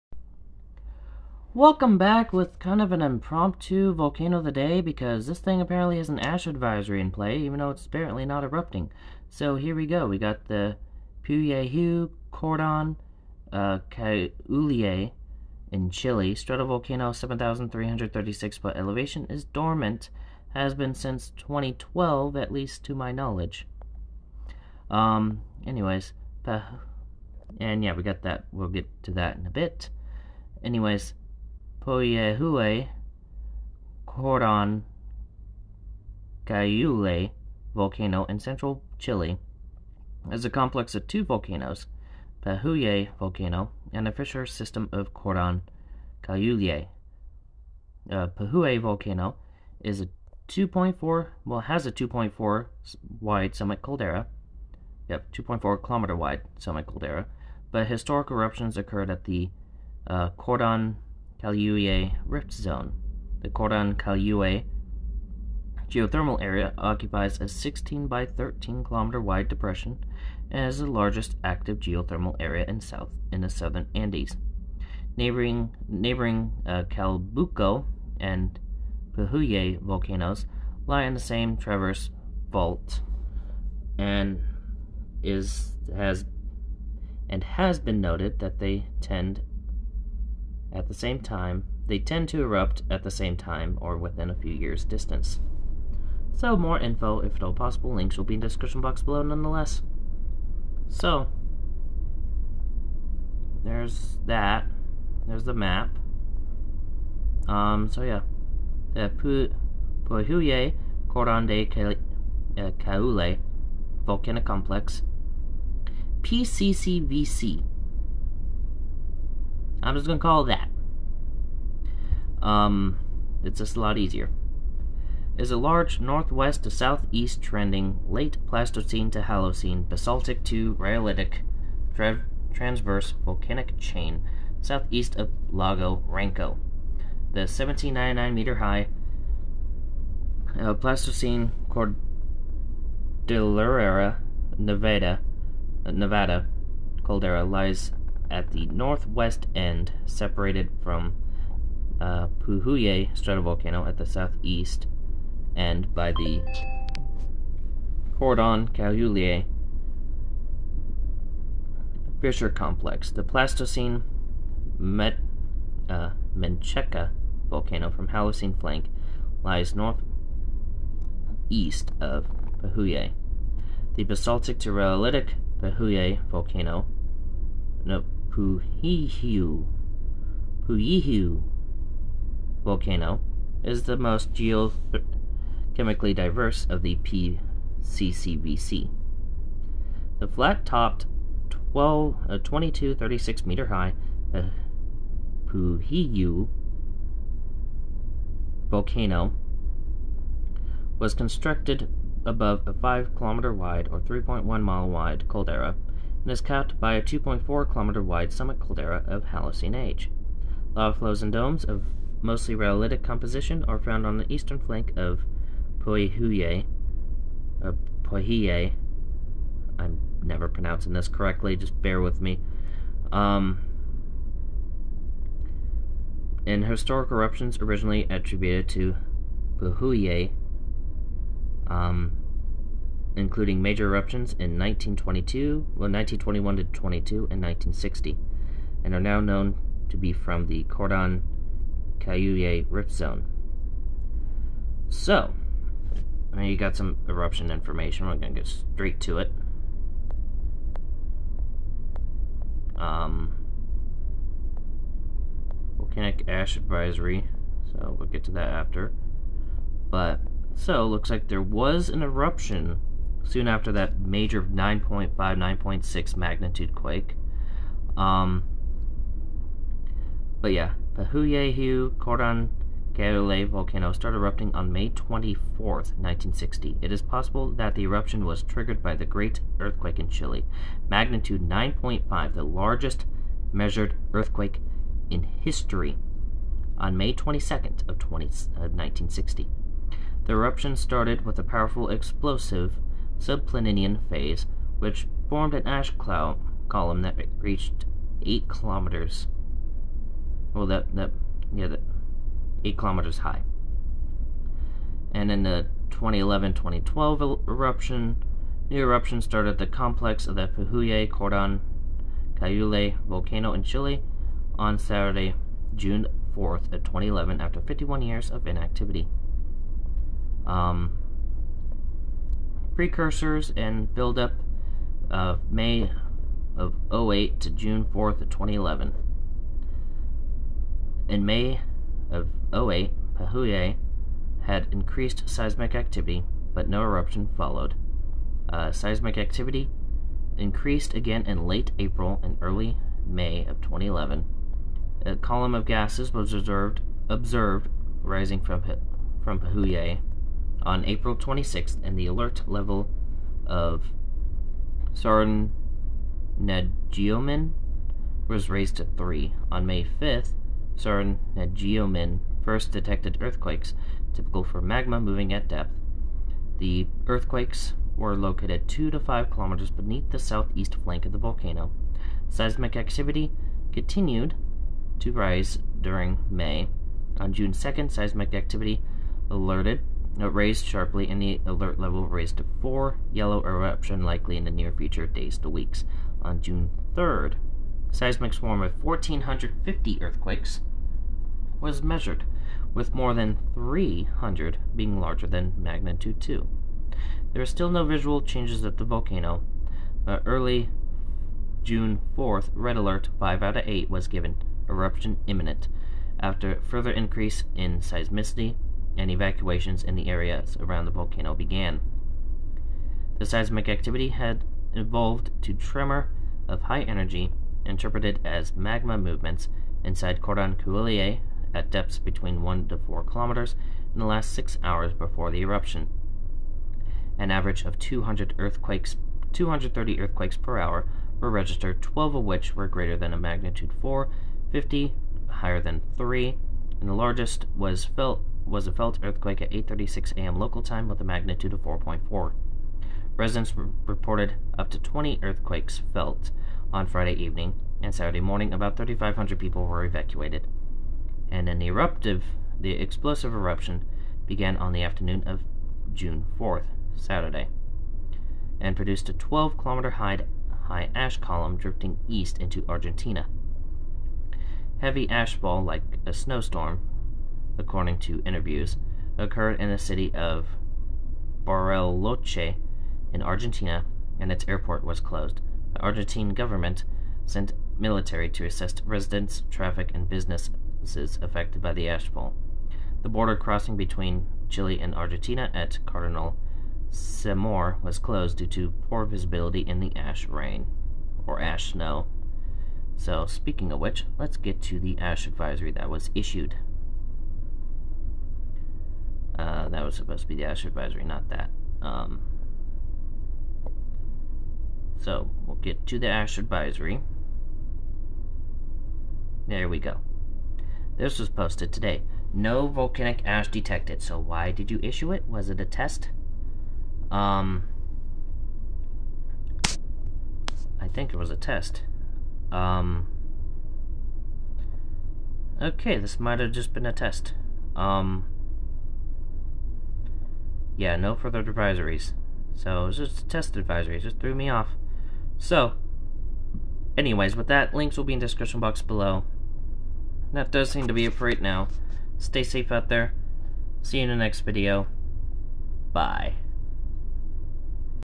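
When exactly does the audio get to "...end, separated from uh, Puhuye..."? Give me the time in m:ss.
2:29.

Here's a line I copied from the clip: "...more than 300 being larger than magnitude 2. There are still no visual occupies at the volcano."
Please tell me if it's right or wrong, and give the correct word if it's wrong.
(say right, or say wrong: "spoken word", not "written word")
wrong: "changes", not "occupies".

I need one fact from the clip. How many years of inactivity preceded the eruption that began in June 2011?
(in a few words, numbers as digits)
51 years.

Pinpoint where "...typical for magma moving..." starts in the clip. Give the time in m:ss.
6:04.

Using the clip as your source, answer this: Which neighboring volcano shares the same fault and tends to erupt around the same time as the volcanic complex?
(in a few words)
Calbuco.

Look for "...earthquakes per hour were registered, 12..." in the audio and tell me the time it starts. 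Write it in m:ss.
7:09.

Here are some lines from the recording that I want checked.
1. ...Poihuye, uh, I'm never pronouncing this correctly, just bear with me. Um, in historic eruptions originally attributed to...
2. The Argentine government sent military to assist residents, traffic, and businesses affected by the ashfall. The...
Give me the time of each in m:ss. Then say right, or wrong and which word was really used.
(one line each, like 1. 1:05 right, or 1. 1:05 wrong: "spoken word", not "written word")
1. 3:35 right
2. 7:55 right.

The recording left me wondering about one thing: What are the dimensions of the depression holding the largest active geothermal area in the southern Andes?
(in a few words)
16 by 13 kilometers.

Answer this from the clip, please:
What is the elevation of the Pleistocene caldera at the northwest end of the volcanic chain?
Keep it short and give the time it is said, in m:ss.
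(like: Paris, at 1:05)
1799 meters, at 2:17.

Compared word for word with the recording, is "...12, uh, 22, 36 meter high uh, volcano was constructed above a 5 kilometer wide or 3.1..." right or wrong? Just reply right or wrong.
right.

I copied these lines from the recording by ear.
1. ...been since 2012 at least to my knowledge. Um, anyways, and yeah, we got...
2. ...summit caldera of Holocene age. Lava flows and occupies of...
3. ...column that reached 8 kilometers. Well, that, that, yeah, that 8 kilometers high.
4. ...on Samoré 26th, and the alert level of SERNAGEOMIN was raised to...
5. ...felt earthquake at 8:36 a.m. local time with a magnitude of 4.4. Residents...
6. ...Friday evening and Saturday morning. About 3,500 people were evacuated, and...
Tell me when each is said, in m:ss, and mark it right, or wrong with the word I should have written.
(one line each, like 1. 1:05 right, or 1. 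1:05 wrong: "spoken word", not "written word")
1. 0:20 right
2. 3:28 wrong: "domes", not "occupies"
3. 4:56 right
4. 5:50 wrong: "April", not "Samoré"
5. 7:18 right
6. 7:26 right.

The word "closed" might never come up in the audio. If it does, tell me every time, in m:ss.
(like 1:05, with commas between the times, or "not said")
7:54, 8:07.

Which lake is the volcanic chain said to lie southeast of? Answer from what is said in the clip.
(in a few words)
Lago Ranco.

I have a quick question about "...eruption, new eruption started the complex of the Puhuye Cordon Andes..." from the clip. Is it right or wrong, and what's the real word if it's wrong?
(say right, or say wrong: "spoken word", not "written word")
wrong: "Cayule", not "Andes".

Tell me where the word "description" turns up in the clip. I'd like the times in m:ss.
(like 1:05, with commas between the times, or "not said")
1:38, 8:58.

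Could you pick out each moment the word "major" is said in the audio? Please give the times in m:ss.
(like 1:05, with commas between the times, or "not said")
3:53, 4:23.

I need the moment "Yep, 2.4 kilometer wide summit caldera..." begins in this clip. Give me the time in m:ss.
0:55.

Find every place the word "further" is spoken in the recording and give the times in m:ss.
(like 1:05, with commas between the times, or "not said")
6:46, 8:51.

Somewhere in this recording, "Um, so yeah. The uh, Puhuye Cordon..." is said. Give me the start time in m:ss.
1:47.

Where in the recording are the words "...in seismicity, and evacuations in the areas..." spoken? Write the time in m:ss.
6:47.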